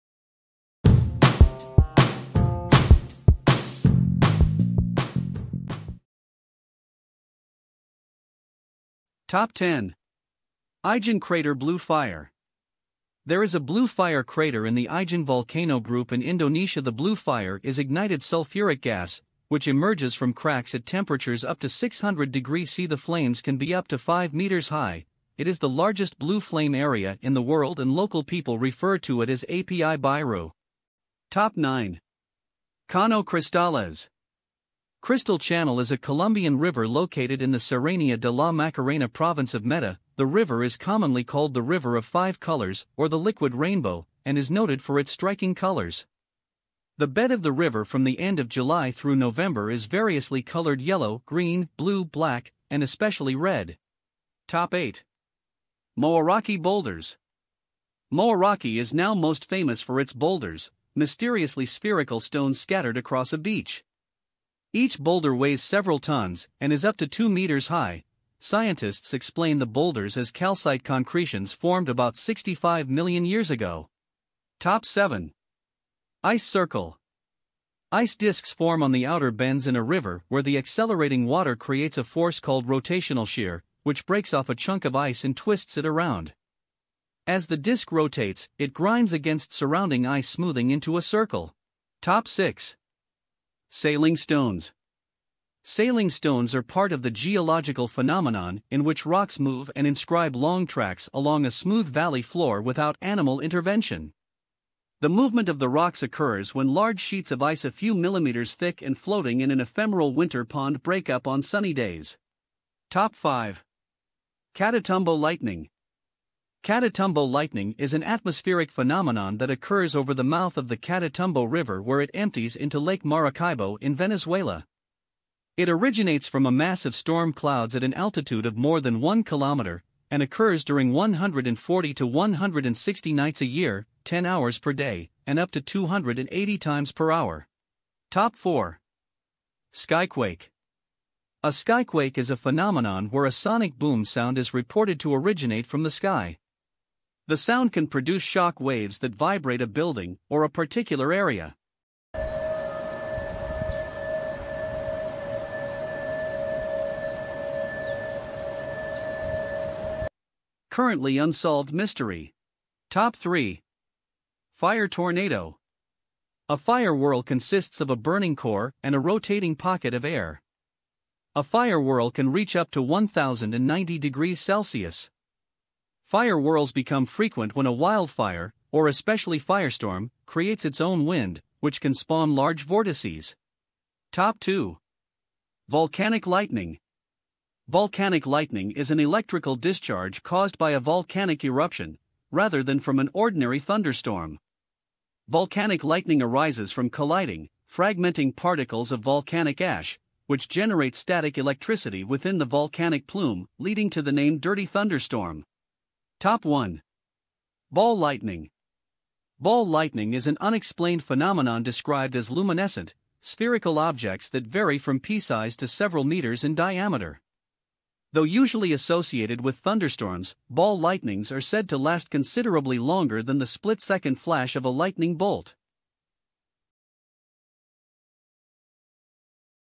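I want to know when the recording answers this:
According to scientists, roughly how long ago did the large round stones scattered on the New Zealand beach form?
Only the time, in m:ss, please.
1:12.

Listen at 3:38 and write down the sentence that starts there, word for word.
Though usually associated with thunderstorms, ball lightnings are said to last considerably longer than the split second flash of a lightning bolt.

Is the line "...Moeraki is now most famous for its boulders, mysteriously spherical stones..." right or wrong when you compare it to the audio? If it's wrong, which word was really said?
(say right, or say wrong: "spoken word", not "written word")
right.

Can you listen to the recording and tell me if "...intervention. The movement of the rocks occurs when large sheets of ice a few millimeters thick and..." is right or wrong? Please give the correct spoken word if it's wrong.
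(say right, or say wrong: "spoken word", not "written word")
right.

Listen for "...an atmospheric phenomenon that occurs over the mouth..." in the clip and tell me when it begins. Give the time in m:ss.
1:57.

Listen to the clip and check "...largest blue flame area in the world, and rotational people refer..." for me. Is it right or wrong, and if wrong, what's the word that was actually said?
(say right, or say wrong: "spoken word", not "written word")
wrong: "local", not "rotational".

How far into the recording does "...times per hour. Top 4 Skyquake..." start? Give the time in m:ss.
2:16.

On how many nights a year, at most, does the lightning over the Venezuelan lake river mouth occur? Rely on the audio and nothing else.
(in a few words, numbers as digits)
160.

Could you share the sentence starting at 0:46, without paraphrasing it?
The bed of the river from the end of July through November is variously colored yellow, green, blue, black, and especially red.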